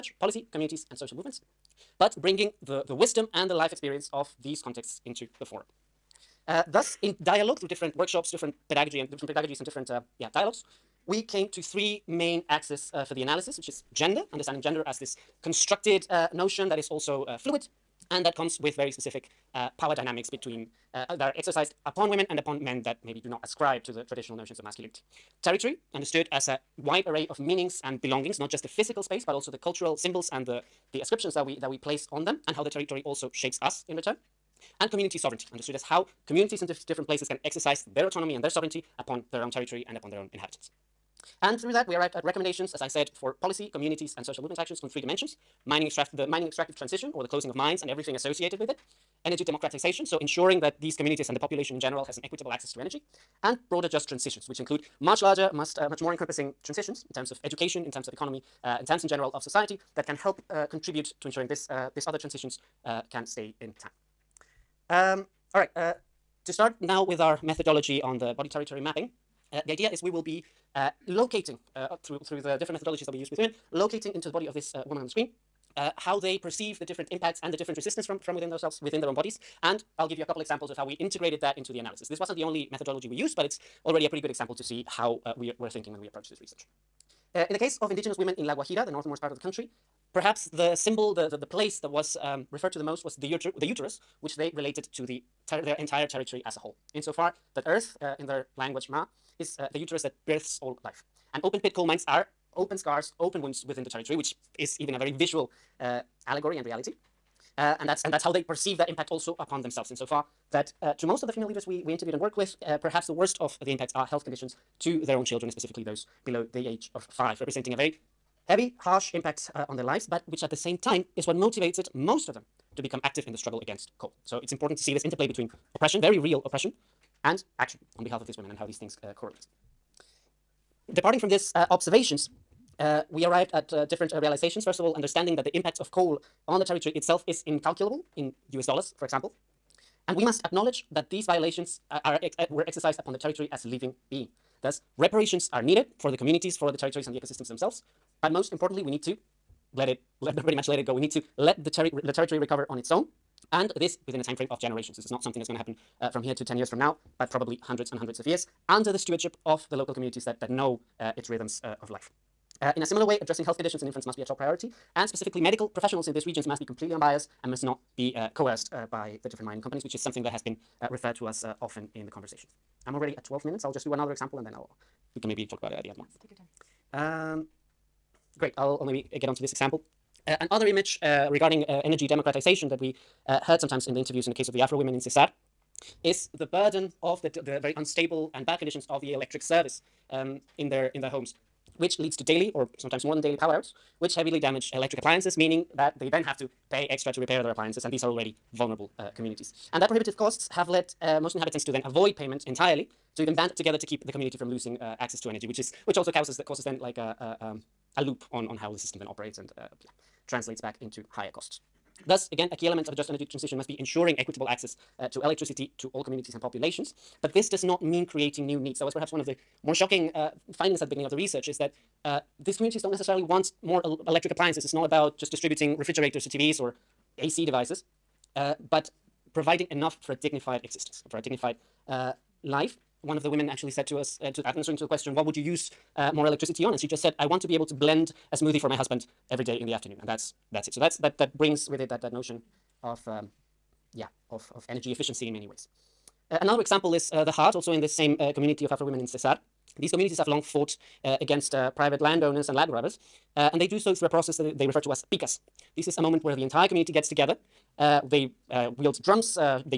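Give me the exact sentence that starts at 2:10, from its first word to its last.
Departing from these uh, observations, uh, we arrived at uh, different uh, realizations.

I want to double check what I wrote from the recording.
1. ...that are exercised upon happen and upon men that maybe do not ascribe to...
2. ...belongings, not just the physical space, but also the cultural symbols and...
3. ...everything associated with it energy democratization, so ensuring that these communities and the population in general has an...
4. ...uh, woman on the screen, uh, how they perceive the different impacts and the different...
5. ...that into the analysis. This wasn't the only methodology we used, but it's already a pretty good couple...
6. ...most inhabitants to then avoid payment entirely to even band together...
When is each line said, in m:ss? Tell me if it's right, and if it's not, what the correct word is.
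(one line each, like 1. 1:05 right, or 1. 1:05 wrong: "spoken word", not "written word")
1. 0:21 wrong: "women", not "happen"
2. 0:28 right
3. 0:47 right
4. 1:14 right
5. 1:21 wrong: "example", not "couple"
6. 3:21 right.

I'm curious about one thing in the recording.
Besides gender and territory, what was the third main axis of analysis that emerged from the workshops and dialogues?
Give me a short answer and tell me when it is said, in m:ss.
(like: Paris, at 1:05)
Community sovereignty, at 0:34.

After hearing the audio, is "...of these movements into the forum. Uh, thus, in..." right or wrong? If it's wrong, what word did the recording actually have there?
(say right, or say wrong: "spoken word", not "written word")
wrong: "contexts", not "movements".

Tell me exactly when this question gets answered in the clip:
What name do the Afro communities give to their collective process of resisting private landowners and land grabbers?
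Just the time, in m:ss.
4:15.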